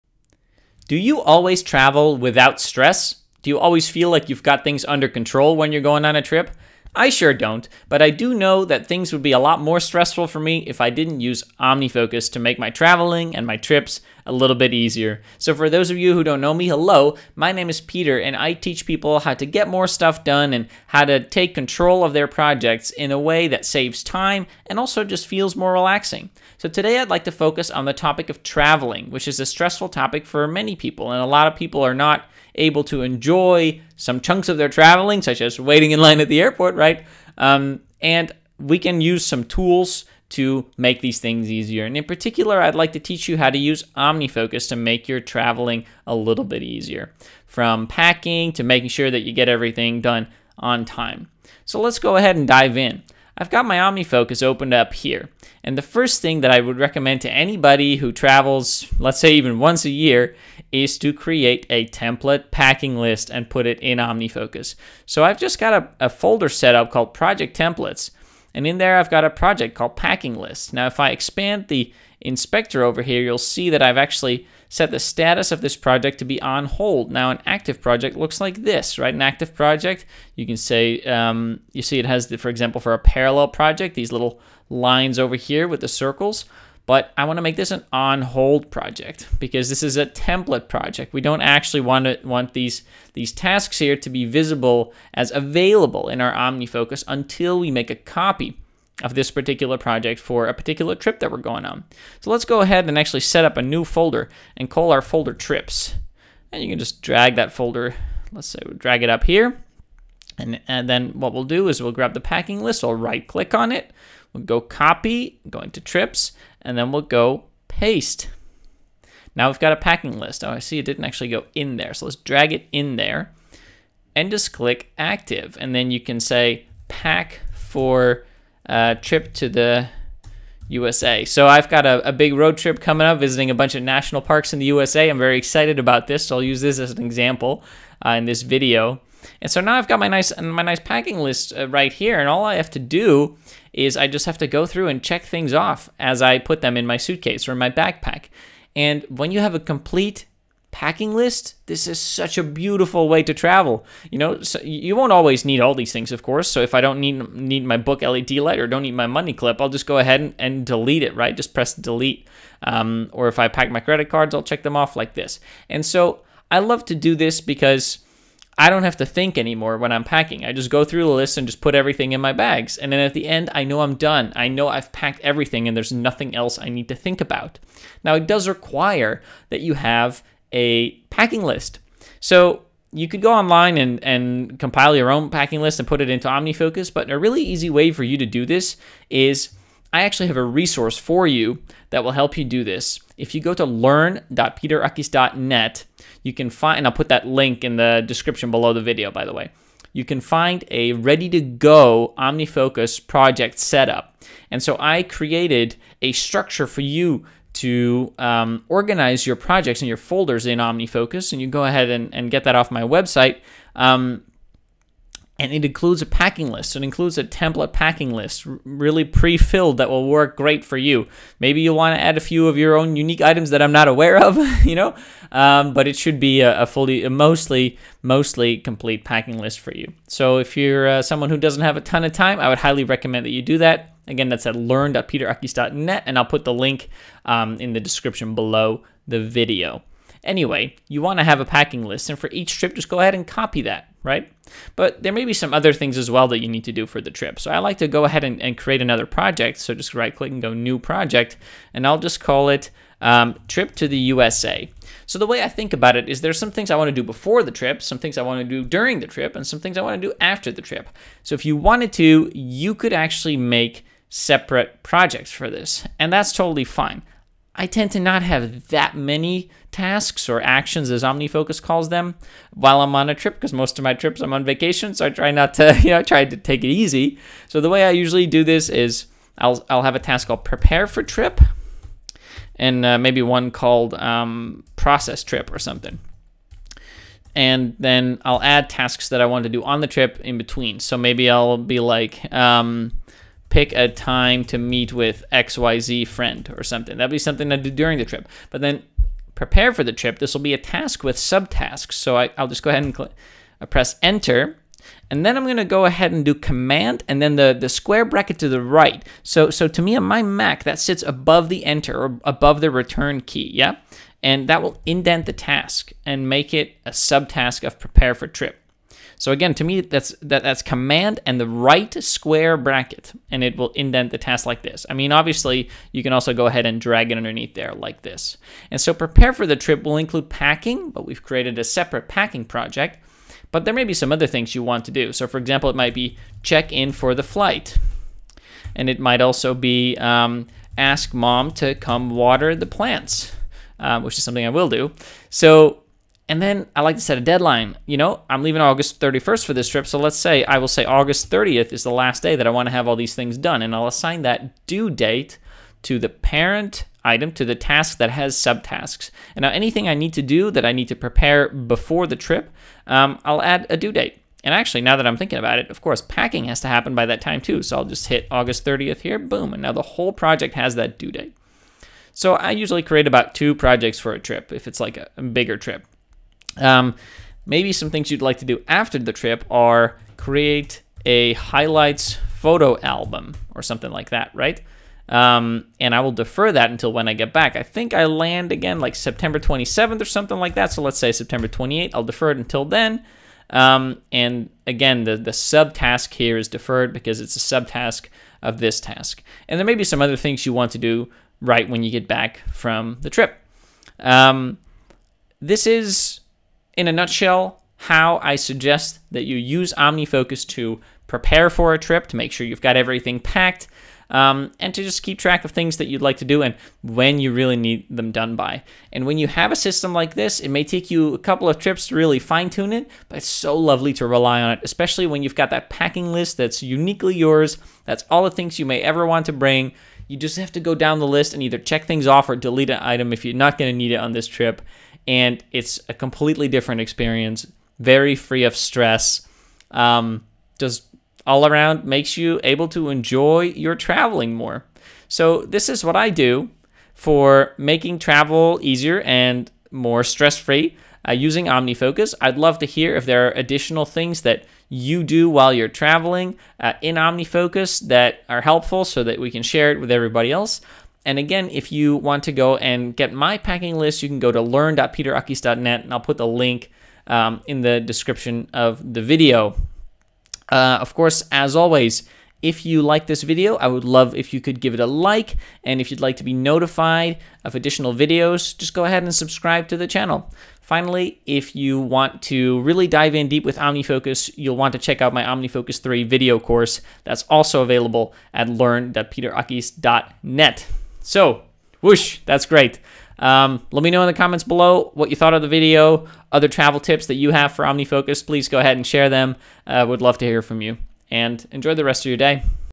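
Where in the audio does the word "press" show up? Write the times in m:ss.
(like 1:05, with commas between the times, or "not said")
2:41, 5:03.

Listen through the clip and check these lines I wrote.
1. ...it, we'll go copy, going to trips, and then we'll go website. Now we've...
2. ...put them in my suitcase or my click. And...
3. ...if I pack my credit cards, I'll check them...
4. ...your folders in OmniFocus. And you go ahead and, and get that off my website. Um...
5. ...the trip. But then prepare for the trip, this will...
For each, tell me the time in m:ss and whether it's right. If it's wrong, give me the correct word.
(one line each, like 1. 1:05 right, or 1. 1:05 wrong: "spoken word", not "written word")
1. 1:53 wrong: "paste", not "website"
2. 2:26 wrong: "backpack", not "click"
3. 2:43 right
4. 3:29 right
5. 4:57 right.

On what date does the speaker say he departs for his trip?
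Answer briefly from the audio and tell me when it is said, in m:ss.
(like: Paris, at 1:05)
August 31st, at 5:48.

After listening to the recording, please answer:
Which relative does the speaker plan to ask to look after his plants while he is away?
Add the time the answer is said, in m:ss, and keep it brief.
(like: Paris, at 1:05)
Mom, at 5:41.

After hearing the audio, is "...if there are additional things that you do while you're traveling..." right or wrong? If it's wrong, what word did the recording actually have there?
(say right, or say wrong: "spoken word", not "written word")
right.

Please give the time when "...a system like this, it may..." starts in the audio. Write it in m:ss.
6:59.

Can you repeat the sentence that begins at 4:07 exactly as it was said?
So I like to go ahead and, and create another project.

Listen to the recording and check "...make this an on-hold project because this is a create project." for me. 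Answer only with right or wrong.
wrong.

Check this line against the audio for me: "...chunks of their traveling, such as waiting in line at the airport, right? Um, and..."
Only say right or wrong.
right.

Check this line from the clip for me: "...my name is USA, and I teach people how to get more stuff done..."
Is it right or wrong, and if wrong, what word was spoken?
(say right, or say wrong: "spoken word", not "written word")
wrong: "Peter", not "USA".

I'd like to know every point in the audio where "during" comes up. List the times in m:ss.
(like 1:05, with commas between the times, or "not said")
4:18, 4:57.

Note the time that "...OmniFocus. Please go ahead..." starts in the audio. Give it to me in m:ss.
8:17.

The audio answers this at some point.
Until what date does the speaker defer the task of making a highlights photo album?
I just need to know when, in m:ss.
6:31.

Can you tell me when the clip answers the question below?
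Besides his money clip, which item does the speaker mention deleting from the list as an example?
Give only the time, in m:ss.
2:37.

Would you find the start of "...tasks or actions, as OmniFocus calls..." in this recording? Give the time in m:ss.
4:29.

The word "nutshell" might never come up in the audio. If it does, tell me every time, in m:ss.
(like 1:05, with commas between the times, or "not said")
6:46.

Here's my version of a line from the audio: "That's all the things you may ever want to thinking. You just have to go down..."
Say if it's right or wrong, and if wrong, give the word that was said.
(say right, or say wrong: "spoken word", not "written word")
wrong: "bring", not "thinking".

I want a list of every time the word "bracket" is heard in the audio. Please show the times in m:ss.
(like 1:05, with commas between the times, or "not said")
5:08, 5:22.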